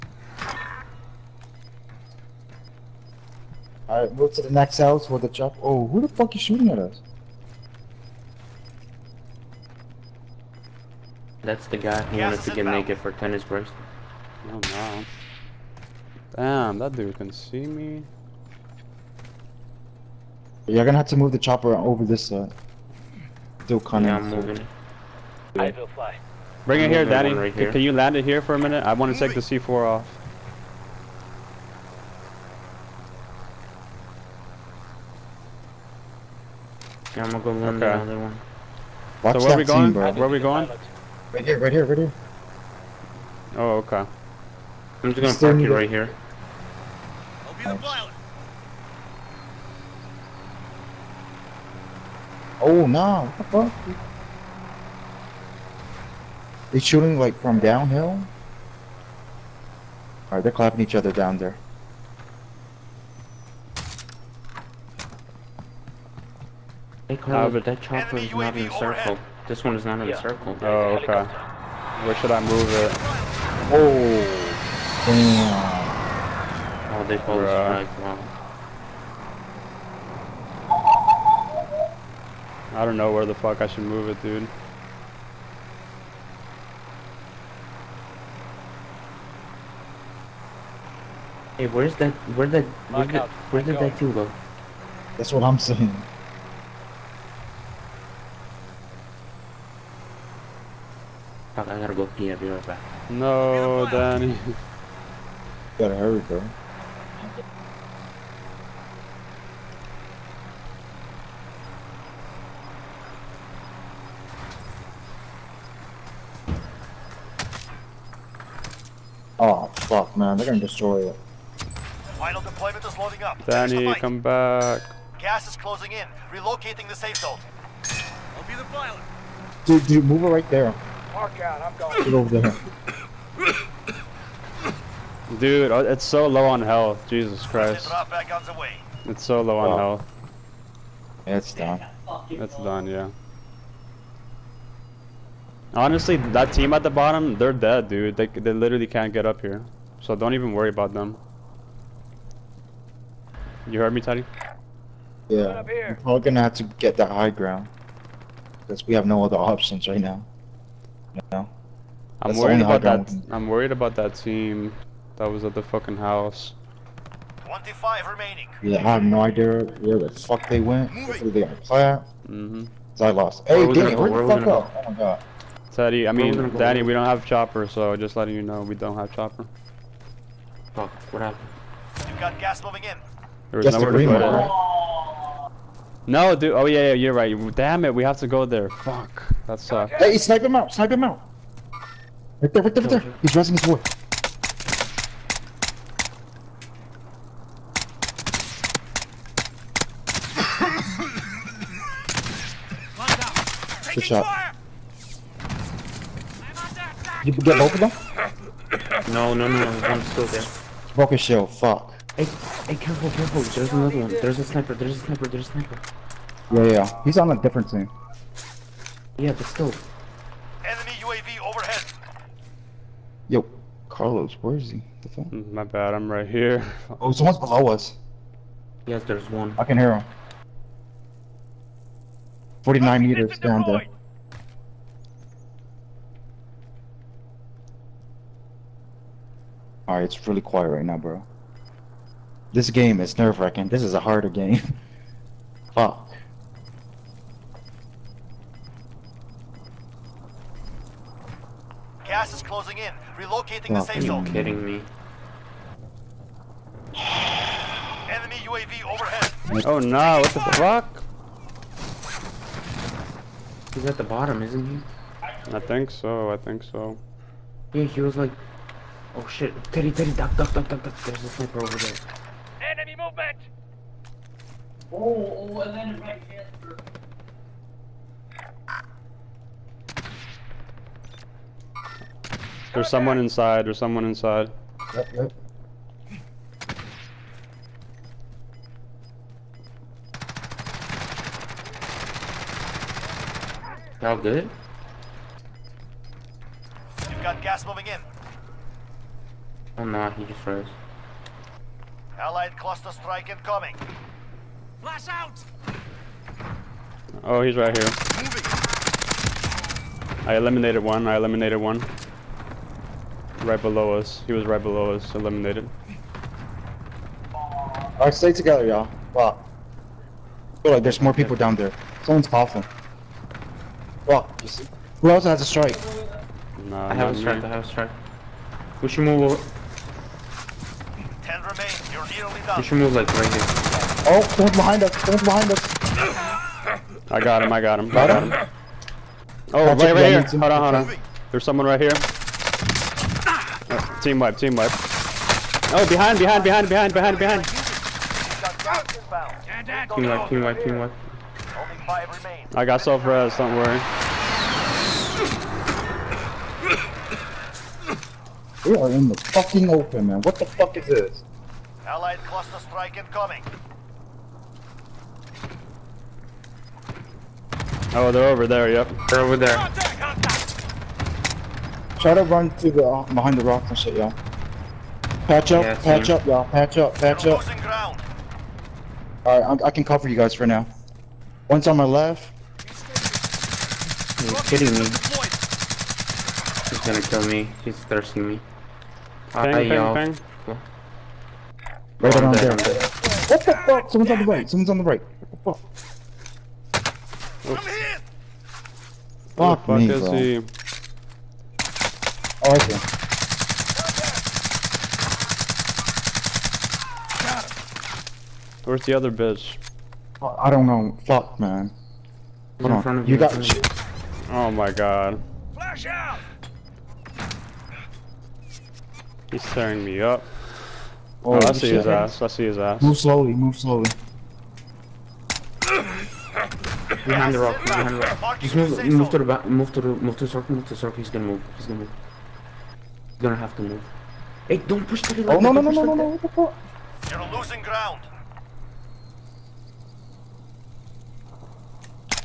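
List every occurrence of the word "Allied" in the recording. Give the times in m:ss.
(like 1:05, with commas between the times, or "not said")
5:02, 6:01.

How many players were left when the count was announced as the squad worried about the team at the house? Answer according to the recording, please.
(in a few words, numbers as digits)
25.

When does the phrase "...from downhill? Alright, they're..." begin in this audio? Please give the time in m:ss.
0:57.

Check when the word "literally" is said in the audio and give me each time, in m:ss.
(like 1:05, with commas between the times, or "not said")
2:28.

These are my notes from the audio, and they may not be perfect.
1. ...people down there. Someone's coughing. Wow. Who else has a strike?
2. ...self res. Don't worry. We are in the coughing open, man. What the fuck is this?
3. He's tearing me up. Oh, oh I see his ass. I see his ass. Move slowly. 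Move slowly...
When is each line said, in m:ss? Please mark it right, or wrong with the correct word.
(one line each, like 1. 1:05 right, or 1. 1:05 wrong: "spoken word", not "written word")
1. 5:21 right
2. 5:52 wrong: "fucking", not "coughing"
3. 6:59 right.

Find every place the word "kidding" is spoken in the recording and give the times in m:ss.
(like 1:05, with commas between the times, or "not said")
4:14, 6:24.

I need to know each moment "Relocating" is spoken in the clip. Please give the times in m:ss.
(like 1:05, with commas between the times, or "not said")
2:06, 4:13.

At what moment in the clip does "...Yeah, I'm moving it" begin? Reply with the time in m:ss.
0:23.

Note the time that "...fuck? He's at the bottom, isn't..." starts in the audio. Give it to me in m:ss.
4:20.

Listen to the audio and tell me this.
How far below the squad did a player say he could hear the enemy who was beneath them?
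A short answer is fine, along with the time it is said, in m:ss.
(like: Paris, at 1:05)
49 meters, at 3:52.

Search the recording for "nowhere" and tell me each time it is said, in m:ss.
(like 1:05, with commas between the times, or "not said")
3:03.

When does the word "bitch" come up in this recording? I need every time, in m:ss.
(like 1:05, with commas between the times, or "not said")
6:49.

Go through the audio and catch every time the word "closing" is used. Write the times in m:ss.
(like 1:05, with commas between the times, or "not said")
2:05, 4:12.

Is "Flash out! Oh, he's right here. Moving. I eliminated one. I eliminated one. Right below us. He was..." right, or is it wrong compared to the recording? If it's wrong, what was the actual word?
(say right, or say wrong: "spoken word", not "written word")
right.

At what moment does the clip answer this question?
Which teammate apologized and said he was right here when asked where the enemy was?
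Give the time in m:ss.
3:43.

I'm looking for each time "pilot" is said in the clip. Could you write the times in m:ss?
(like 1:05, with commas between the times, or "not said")
0:40, 0:47, 2:08.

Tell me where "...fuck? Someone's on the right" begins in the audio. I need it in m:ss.
6:33.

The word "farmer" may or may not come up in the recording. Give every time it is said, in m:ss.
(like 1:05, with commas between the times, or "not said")
not said.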